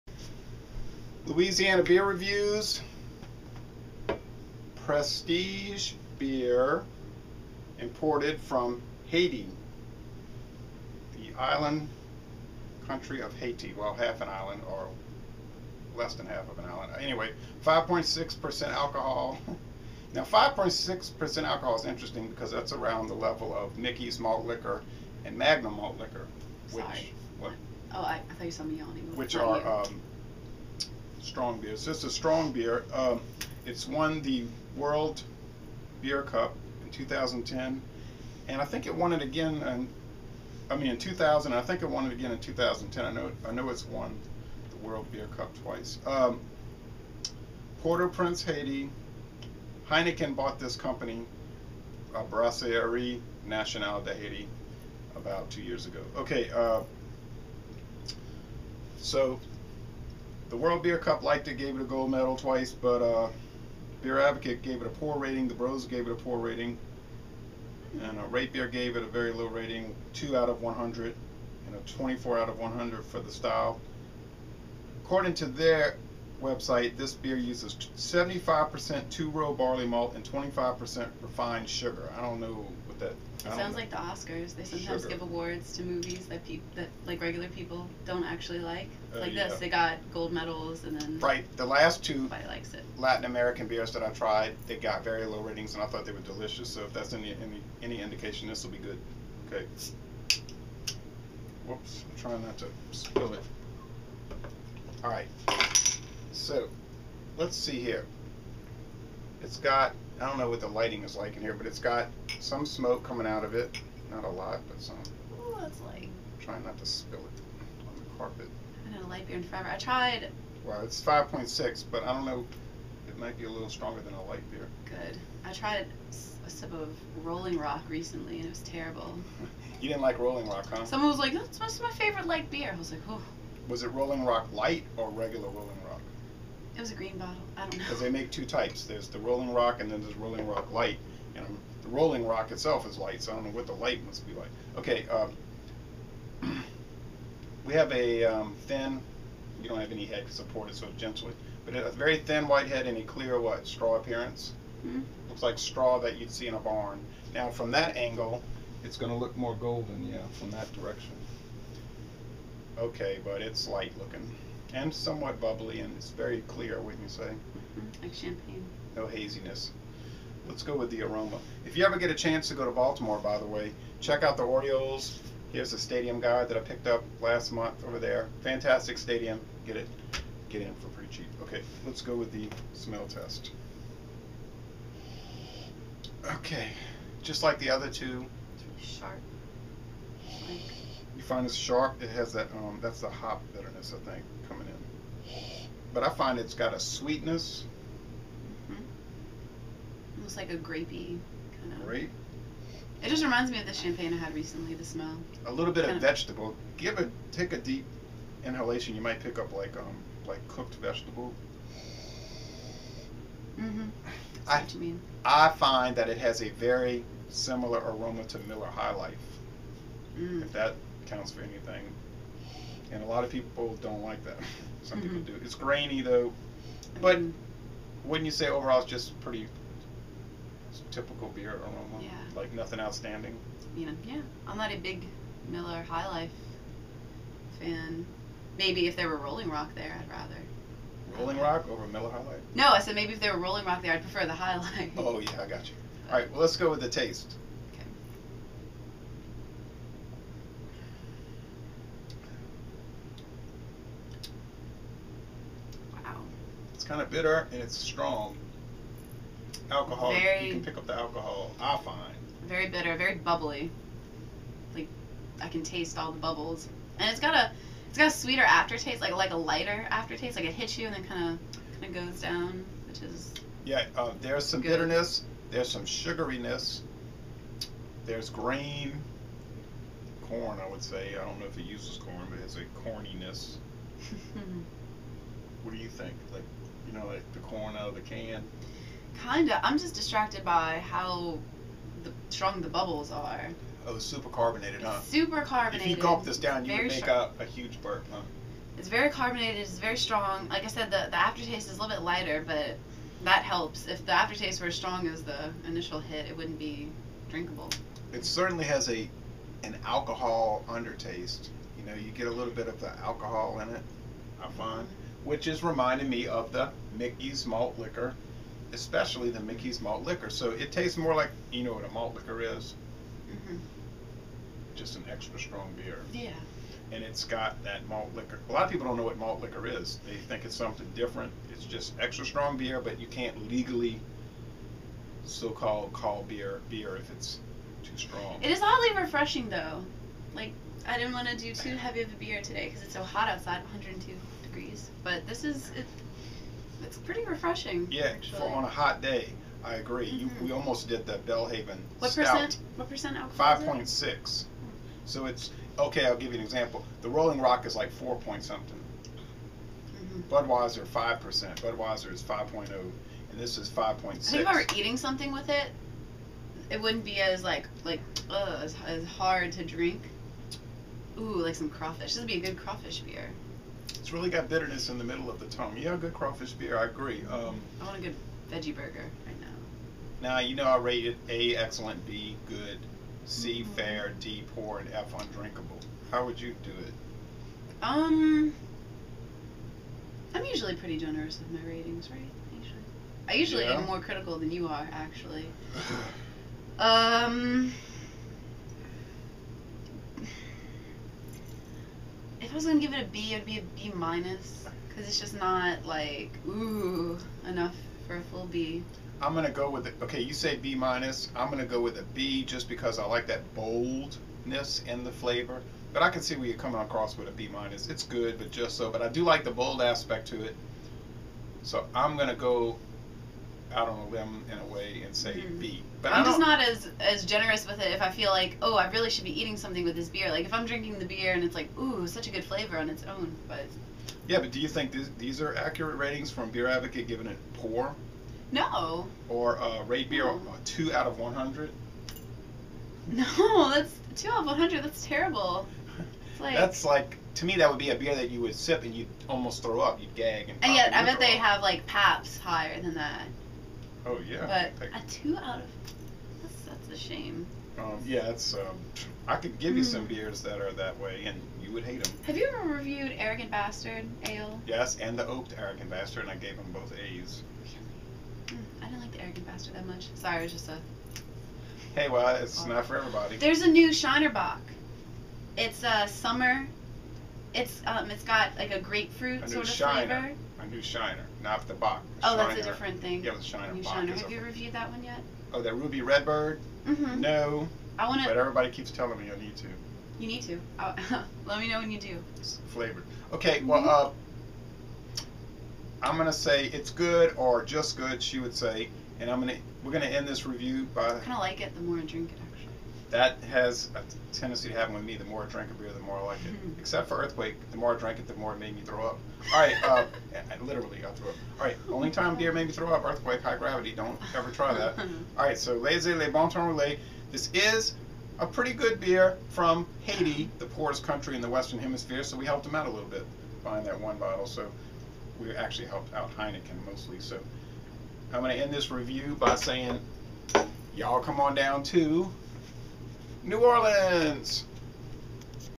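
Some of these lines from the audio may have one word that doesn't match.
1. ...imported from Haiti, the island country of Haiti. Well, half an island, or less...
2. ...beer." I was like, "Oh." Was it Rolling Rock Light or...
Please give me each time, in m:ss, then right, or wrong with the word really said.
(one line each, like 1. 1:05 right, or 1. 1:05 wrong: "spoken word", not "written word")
1. 0:07 right
2. 2:12 right.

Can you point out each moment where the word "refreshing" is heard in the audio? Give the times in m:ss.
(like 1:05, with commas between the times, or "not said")
5:39, 5:47.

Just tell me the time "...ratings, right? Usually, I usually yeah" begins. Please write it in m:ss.
6:31.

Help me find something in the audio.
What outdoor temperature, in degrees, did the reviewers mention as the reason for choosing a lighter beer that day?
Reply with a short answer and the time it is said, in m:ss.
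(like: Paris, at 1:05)
102, at 5:43.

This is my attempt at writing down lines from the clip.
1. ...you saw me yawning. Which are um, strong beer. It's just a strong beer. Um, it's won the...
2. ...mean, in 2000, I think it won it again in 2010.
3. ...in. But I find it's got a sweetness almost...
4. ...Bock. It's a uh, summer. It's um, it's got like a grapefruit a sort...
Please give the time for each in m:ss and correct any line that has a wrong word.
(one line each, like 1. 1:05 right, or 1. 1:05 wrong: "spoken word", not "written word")
1. 0:28 right
2. 0:40 right
3. 3:14 right
4. 7:54 right.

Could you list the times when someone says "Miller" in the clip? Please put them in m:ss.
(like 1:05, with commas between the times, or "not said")
3:38, 3:55, 4:01.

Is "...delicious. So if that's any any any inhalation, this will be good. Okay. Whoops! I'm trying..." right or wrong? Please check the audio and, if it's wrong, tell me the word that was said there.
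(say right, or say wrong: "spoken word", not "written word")
wrong: "indication", not "inhalation".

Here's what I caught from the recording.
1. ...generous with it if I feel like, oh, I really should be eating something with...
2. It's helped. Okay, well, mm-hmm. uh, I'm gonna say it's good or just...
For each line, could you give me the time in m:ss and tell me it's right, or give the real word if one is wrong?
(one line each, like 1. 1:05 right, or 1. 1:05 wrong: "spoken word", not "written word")
1. 7:07 right
2. 8:12 wrong: "flavored", not "helped".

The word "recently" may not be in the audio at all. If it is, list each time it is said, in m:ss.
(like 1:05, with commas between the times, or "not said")
2:07, 3:24.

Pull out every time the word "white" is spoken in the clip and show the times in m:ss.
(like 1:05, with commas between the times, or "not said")
2:32.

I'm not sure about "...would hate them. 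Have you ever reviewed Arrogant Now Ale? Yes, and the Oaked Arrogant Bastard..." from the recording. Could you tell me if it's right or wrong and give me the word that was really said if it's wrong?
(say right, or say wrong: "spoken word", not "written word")
wrong: "Bastard", not "Now".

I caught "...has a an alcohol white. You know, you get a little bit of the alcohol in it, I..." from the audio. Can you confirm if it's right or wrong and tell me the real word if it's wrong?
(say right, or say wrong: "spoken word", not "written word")
wrong: "undertaste", not "white".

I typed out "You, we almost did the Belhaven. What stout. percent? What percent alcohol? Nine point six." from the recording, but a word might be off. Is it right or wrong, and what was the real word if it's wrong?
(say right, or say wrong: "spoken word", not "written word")
wrong: "Five", not "Nine".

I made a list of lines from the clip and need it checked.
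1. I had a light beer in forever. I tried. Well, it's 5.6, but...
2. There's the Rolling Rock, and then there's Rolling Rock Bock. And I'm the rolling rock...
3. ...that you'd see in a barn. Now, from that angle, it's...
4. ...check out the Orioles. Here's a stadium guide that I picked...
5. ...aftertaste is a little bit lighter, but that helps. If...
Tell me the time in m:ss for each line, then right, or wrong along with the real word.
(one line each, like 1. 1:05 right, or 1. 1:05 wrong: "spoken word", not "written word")
1. 1:58 right
2. 2:18 wrong: "Light", not "Bock"
3. 2:36 right
4. 2:53 right
5. 5:01 right.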